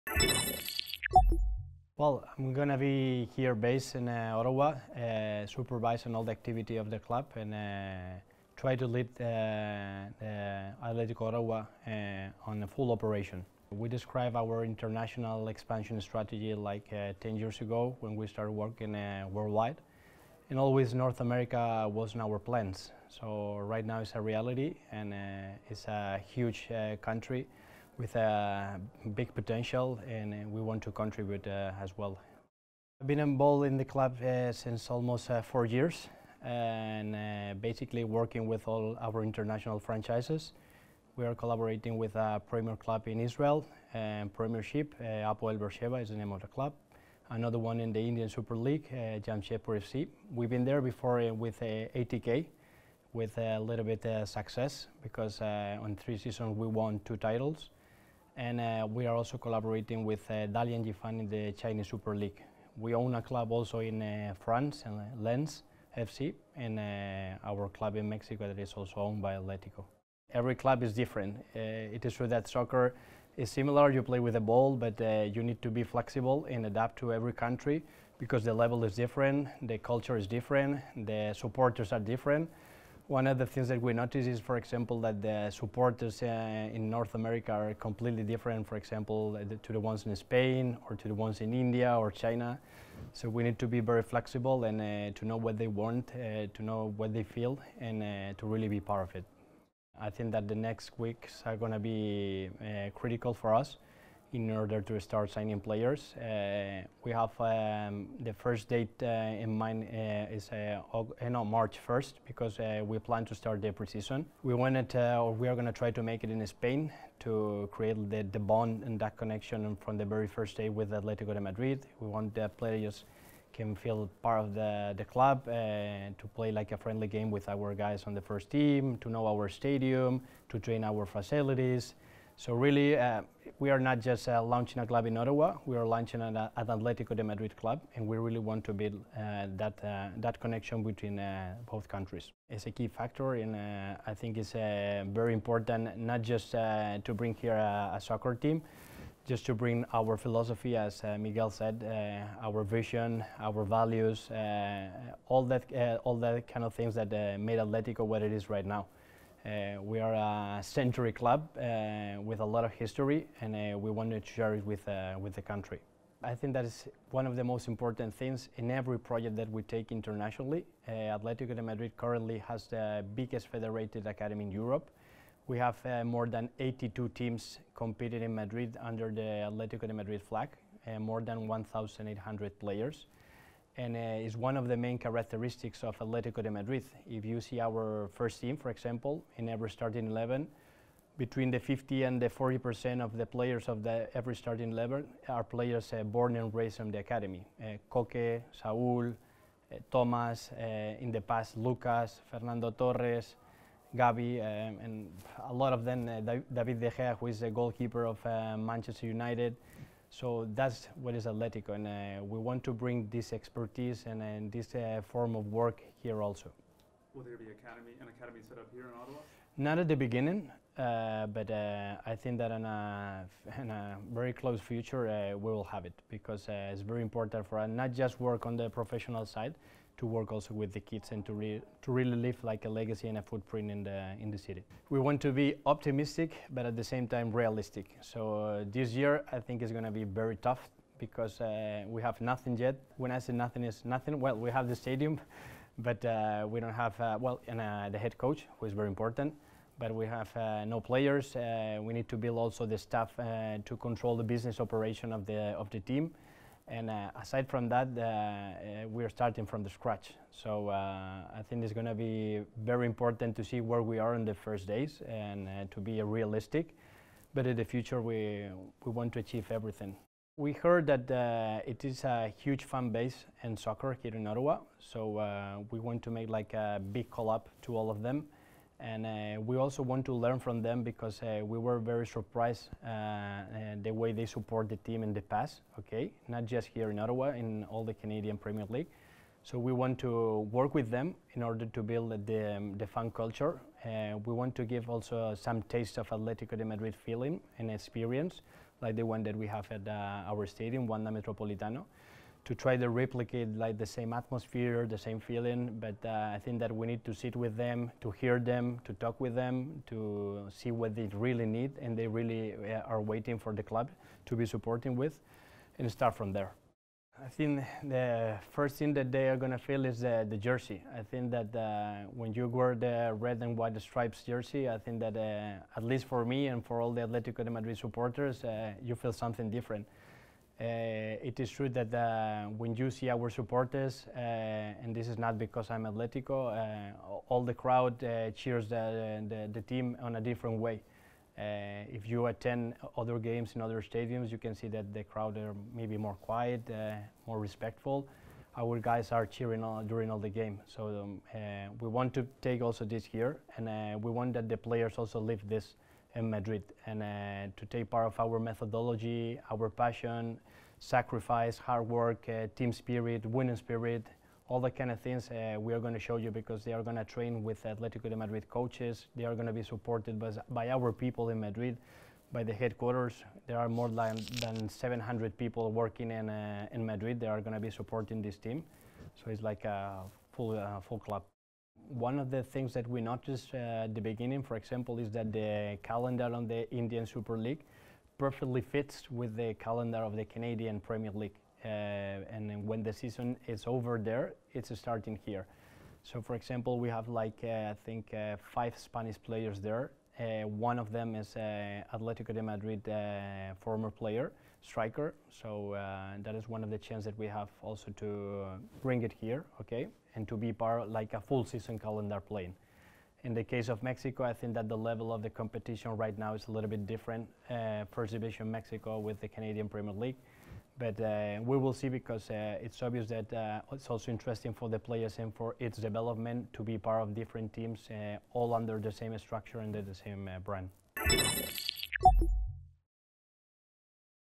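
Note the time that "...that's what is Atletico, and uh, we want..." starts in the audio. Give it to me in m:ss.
3:30.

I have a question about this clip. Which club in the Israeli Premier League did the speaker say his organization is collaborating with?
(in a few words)
Apoel Beersheba.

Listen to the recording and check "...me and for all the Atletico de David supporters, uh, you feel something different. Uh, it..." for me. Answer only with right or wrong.
wrong.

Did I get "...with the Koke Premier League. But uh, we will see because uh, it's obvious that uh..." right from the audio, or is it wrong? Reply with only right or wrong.
wrong.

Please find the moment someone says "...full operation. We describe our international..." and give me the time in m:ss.
0:12.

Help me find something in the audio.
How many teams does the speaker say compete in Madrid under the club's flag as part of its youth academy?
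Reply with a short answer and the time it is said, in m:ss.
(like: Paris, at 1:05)
82, at 2:56.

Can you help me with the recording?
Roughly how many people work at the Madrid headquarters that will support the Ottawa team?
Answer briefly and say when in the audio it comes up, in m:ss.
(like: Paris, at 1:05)
700, at 6:14.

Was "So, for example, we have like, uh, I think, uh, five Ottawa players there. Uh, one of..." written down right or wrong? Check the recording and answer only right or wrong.
wrong.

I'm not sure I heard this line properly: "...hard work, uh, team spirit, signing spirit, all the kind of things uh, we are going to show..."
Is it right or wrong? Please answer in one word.
wrong.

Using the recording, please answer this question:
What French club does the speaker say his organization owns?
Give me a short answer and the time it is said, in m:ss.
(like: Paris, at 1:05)
Lens FC, at 1:05.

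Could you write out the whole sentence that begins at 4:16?
And uh, aside from that, uh, uh, we're starting from the scratch.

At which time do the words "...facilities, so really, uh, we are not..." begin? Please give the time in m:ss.
2:11.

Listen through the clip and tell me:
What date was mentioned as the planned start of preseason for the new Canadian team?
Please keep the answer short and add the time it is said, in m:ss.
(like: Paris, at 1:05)
March 1, at 1:51.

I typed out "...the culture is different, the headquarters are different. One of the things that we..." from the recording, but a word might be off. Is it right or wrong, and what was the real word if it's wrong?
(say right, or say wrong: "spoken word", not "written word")
wrong: "supporters", not "headquarters".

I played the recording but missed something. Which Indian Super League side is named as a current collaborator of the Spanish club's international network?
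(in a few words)
Jamshedpur FC.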